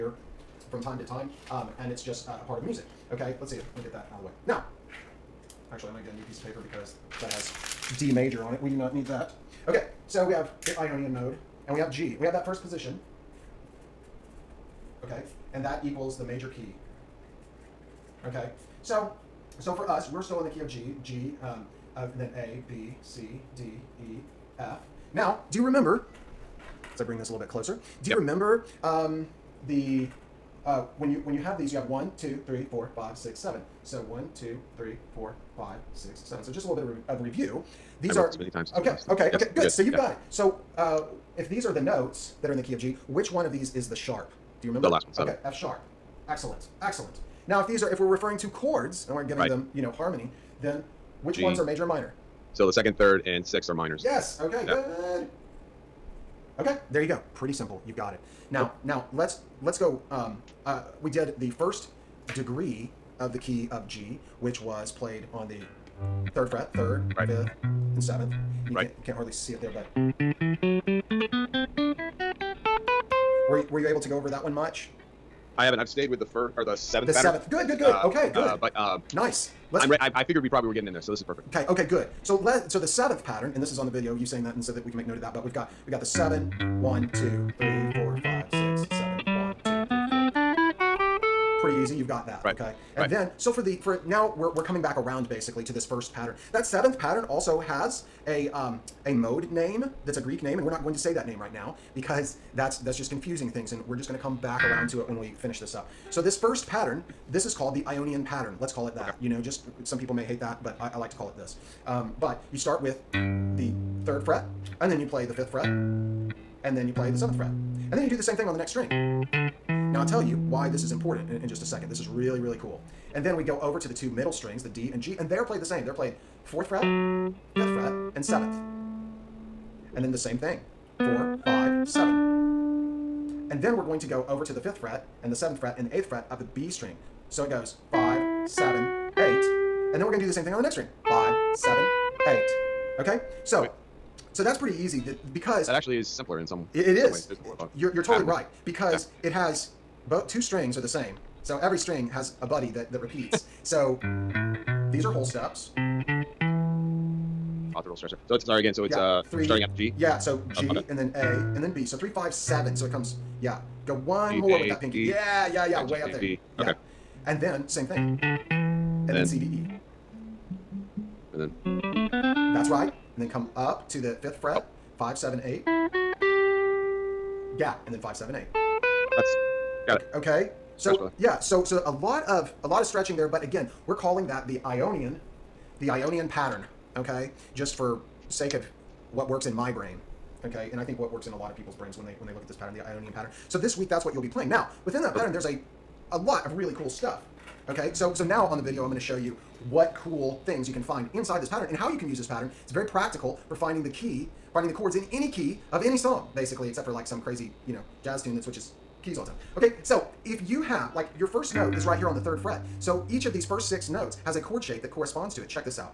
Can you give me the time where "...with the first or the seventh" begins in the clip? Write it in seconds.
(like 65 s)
76 s.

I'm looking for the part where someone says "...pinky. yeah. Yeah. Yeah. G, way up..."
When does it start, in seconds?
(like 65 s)
164 s.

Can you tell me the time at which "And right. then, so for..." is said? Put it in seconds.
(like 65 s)
92 s.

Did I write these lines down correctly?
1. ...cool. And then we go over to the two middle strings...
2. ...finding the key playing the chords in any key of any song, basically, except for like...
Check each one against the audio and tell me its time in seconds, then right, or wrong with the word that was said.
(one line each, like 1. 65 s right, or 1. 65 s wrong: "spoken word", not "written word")
1. 122 s right
2. 203 s wrong: "finding", not "playing".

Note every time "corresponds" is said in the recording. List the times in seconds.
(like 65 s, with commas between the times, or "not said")
214 s.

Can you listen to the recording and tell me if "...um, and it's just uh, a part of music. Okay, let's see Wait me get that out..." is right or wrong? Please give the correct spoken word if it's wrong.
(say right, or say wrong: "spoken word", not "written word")
wrong: "Let", not "Wait".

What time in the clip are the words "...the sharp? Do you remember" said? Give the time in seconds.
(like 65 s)
43 s.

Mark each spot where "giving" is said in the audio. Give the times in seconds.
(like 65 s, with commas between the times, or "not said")
49 s.